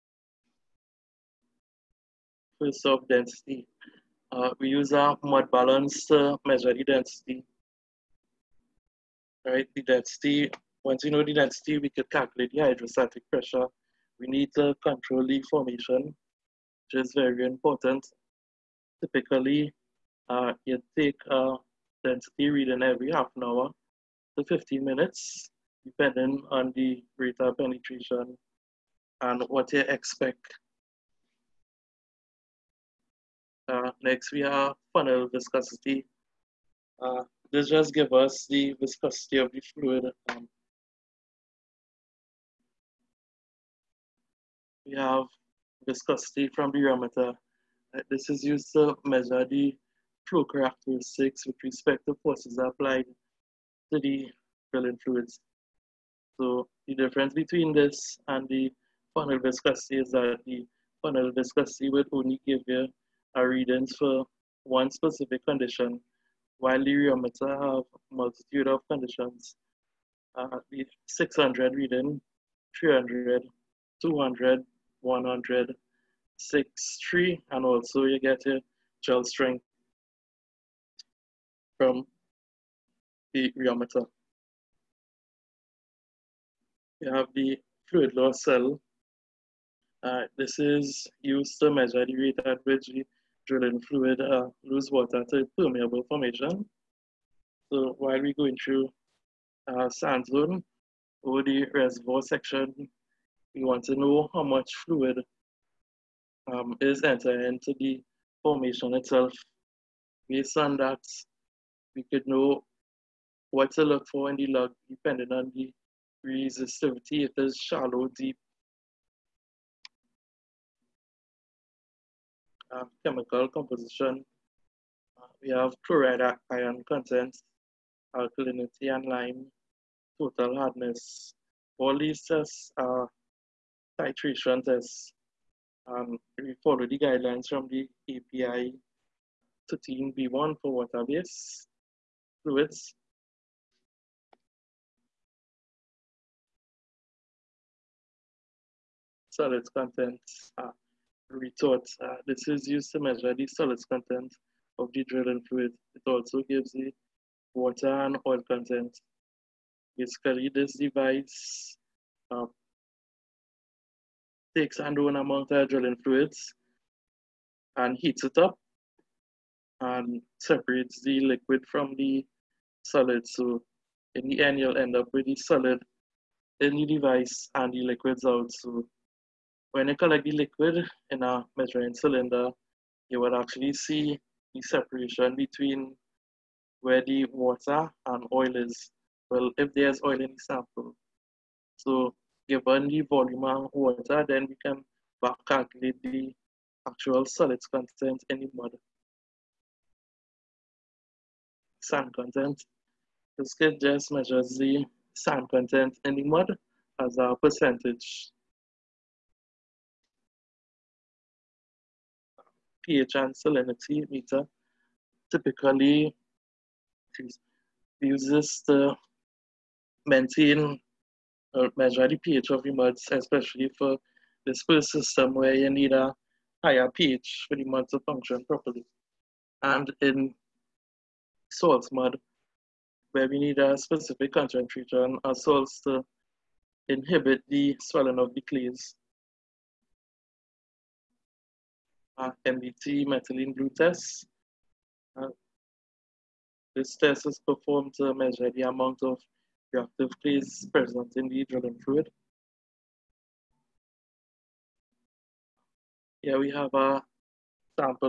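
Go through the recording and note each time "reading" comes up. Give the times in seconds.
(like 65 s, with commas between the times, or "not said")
22 s, 63 s, 71 s.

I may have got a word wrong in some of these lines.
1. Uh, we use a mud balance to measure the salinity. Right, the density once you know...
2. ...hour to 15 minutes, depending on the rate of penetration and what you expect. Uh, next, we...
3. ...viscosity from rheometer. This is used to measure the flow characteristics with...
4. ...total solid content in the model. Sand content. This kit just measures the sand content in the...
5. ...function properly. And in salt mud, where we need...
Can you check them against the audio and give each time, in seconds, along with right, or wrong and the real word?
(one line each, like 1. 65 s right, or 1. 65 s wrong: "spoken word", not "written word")
1. 4 s wrong: "density", not "salinity"
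2. 23 s right
3. 45 s right
4. 196 s wrong: "actual", not "total"
5. 228 s right.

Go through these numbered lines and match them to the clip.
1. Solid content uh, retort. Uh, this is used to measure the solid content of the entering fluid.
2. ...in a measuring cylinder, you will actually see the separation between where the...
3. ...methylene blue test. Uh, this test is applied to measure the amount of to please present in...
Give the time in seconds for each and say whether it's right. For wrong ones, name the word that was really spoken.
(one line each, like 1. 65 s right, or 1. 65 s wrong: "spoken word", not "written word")
1. 149 s wrong: "drilling", not "entering"
2. 181 s right
3. 243 s wrong: "performed", not "applied".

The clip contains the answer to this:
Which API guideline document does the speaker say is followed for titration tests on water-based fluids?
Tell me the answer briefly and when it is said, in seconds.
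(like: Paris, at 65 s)
API 13B1, at 138 s.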